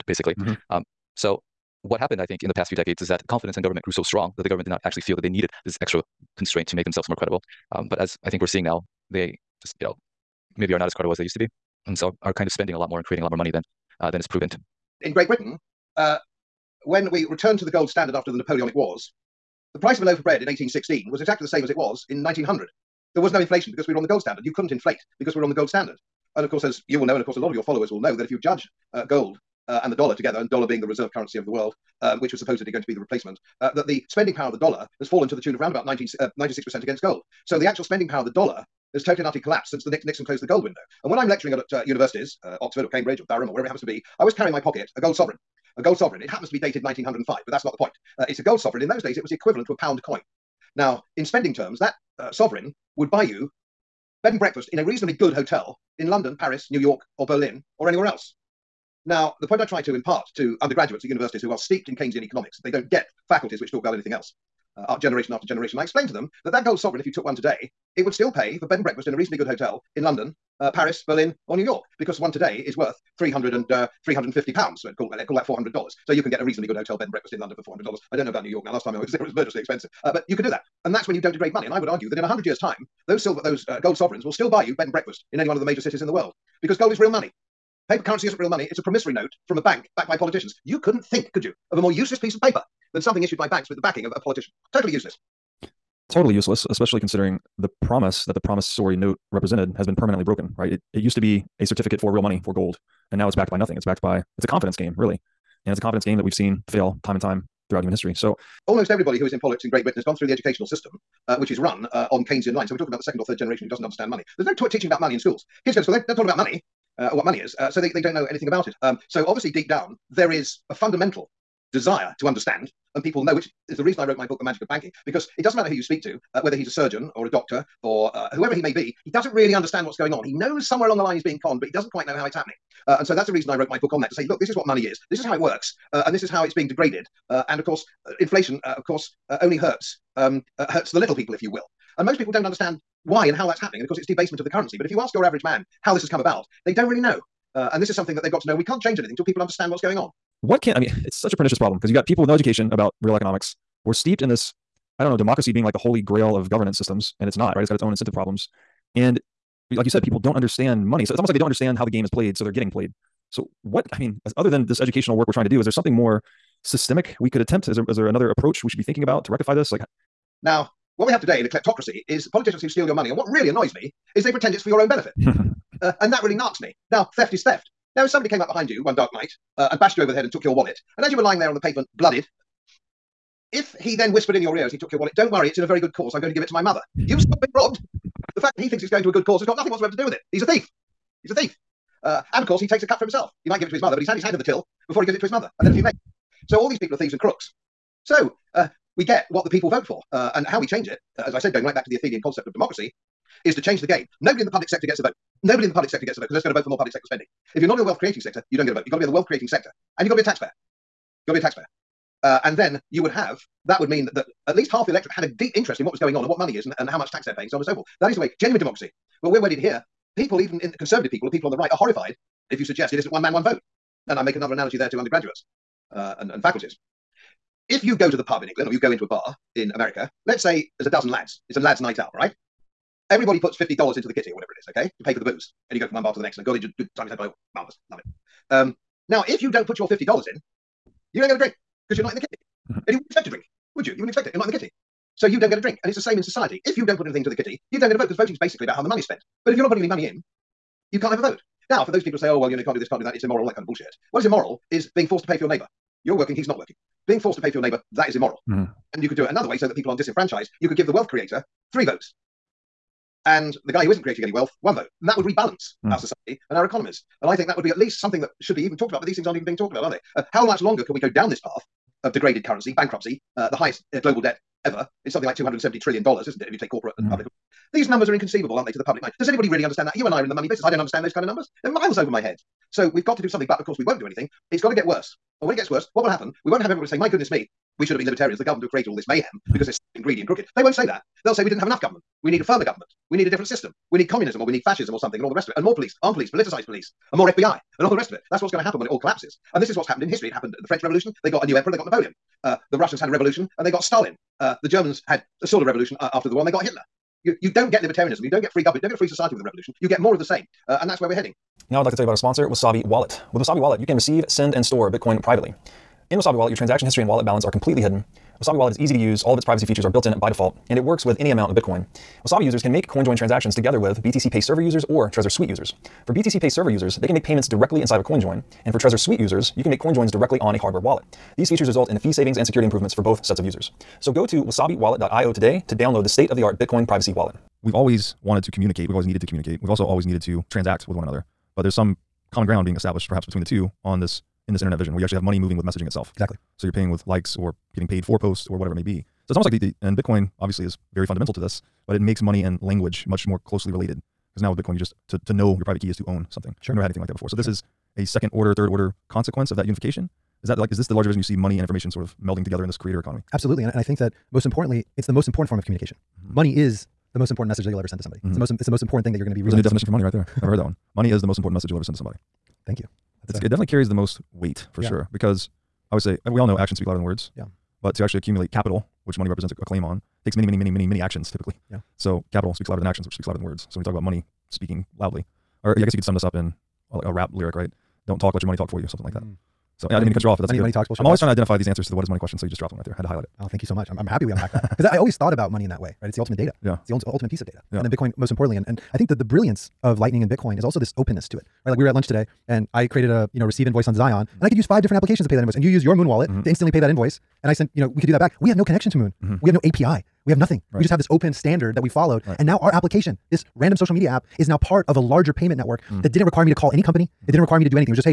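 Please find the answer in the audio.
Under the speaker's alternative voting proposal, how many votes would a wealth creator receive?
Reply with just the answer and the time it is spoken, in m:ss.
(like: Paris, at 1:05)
3, at 4:21.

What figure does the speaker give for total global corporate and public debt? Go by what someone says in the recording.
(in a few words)
$270 trillion.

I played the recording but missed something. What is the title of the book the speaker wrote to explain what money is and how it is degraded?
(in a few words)
The Magic of Banking.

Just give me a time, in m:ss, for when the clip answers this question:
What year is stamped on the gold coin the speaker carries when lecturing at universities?
0:46.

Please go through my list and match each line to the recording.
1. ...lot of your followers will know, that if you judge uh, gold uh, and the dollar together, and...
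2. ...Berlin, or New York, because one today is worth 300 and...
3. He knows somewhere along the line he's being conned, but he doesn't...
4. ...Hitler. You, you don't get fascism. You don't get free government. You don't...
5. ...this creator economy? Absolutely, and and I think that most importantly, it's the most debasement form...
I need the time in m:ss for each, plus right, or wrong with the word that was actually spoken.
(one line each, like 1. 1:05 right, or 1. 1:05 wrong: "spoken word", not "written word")
1. 0:27 right
2. 1:11 right
3. 2:10 right
4. 5:06 wrong: "libertarianism", not "fascism"
5. 6:02 wrong: "important", not "debasement".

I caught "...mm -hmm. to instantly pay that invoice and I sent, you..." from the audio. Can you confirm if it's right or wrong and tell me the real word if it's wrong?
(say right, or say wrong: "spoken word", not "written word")
right.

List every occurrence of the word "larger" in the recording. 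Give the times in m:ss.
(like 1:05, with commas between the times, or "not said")
6:00, 6:54.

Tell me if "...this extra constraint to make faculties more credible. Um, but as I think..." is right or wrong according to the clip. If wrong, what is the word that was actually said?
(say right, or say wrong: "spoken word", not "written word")
wrong: "themselves", not "faculties".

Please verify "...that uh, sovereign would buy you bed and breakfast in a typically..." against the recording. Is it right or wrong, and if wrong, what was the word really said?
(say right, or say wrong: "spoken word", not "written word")
wrong: "reasonably", not "typically".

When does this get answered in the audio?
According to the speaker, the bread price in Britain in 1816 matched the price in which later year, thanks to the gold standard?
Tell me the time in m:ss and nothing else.
0:22.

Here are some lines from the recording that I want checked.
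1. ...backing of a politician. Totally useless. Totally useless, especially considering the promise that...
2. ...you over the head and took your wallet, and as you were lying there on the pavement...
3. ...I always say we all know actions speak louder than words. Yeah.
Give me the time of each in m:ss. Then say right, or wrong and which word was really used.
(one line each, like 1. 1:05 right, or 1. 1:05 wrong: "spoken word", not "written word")
1. 1:33 right
2. 2:59 right
3. 6:15 right.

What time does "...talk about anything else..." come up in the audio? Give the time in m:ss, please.
1:03.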